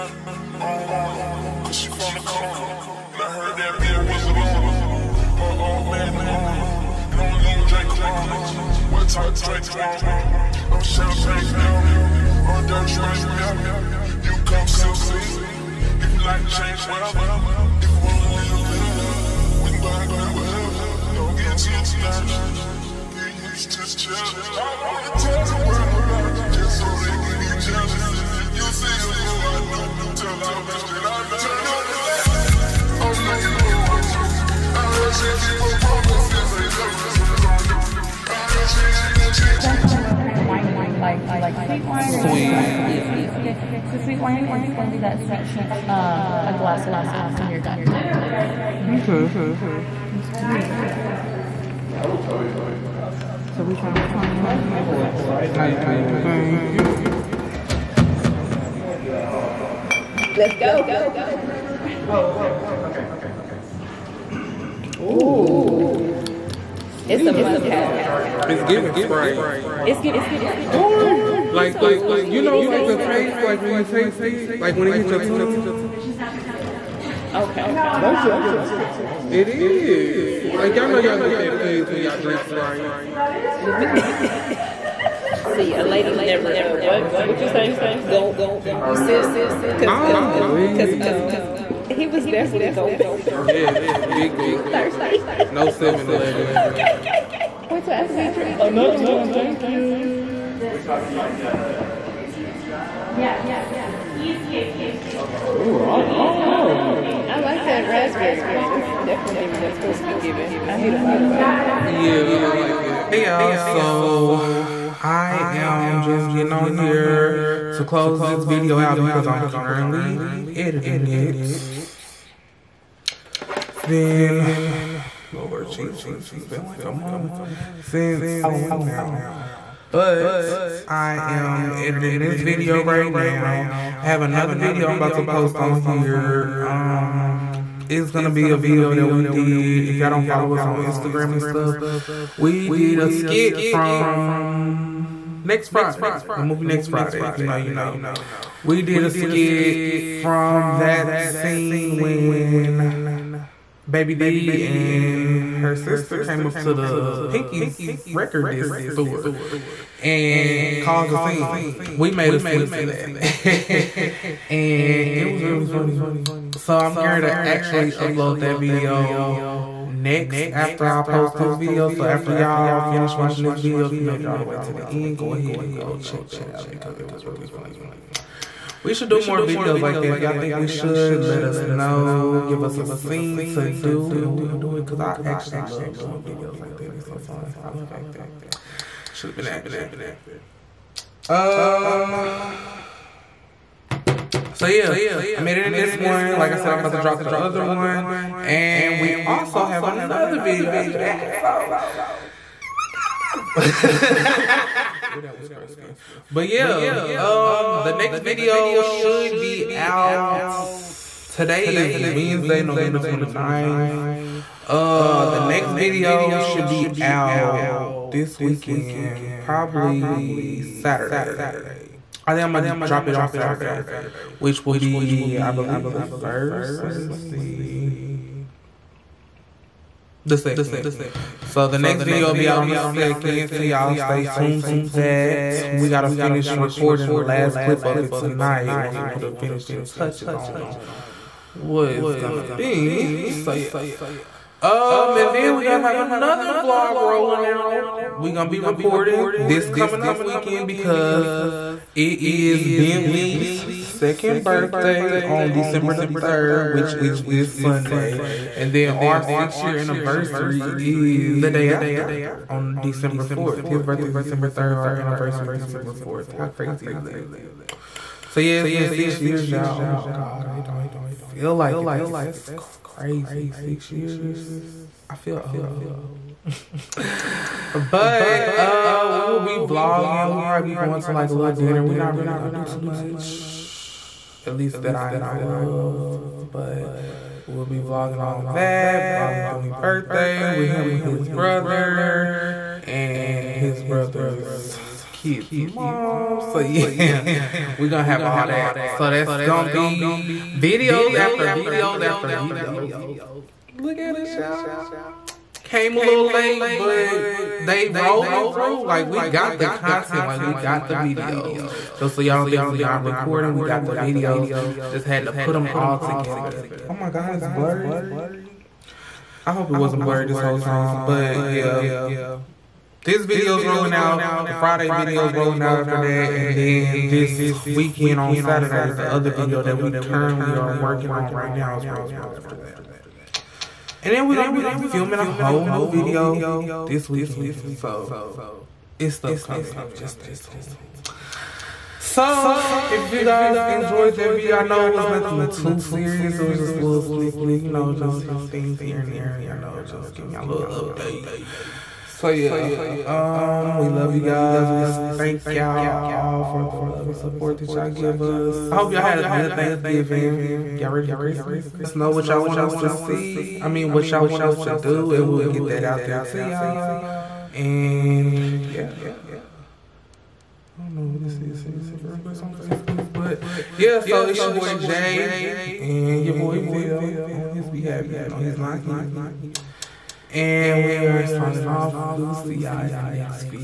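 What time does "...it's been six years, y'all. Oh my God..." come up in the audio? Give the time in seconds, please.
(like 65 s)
268 s.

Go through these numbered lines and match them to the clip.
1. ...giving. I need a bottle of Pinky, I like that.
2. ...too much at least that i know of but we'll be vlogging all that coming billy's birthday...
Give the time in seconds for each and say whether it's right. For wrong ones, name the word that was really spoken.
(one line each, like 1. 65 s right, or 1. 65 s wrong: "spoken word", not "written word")
1. 110 s wrong: "Yeah", not "Pinky"
2. 282 s wrong: "vlogging", not "coming".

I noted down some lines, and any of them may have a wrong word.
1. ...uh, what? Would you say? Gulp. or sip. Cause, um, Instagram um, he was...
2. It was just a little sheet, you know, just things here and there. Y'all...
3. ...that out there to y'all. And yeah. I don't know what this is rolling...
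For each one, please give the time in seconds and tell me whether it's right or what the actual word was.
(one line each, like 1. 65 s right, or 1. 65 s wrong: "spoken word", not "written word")
1. 86 s wrong: "Cause", not "Instagram"
2. 346 s wrong: "snippet", not "sheet"
3. 365 s wrong: "sending", not "rolling".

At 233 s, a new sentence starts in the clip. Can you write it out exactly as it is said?
So y'all stay tuned to that.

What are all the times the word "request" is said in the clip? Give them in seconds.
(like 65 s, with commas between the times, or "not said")
372 s.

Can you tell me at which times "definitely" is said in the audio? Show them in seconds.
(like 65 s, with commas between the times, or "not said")
92 s, 109 s.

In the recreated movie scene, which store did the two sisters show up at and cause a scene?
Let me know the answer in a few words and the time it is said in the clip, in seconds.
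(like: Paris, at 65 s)
Pinky's, at 157 s.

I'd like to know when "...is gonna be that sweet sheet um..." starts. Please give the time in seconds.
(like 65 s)
44 s.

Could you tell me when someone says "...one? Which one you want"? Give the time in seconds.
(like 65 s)
53 s.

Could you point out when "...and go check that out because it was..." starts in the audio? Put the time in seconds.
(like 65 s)
175 s.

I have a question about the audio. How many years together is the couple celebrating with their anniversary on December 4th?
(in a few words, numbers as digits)
6.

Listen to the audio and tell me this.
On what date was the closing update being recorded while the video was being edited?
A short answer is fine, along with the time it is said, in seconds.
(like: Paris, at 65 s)
Wednesday, November 29th, at 211 s.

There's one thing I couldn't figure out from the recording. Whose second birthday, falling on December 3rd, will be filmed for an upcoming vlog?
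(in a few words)
Bentley.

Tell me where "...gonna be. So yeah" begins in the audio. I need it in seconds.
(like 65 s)
242 s.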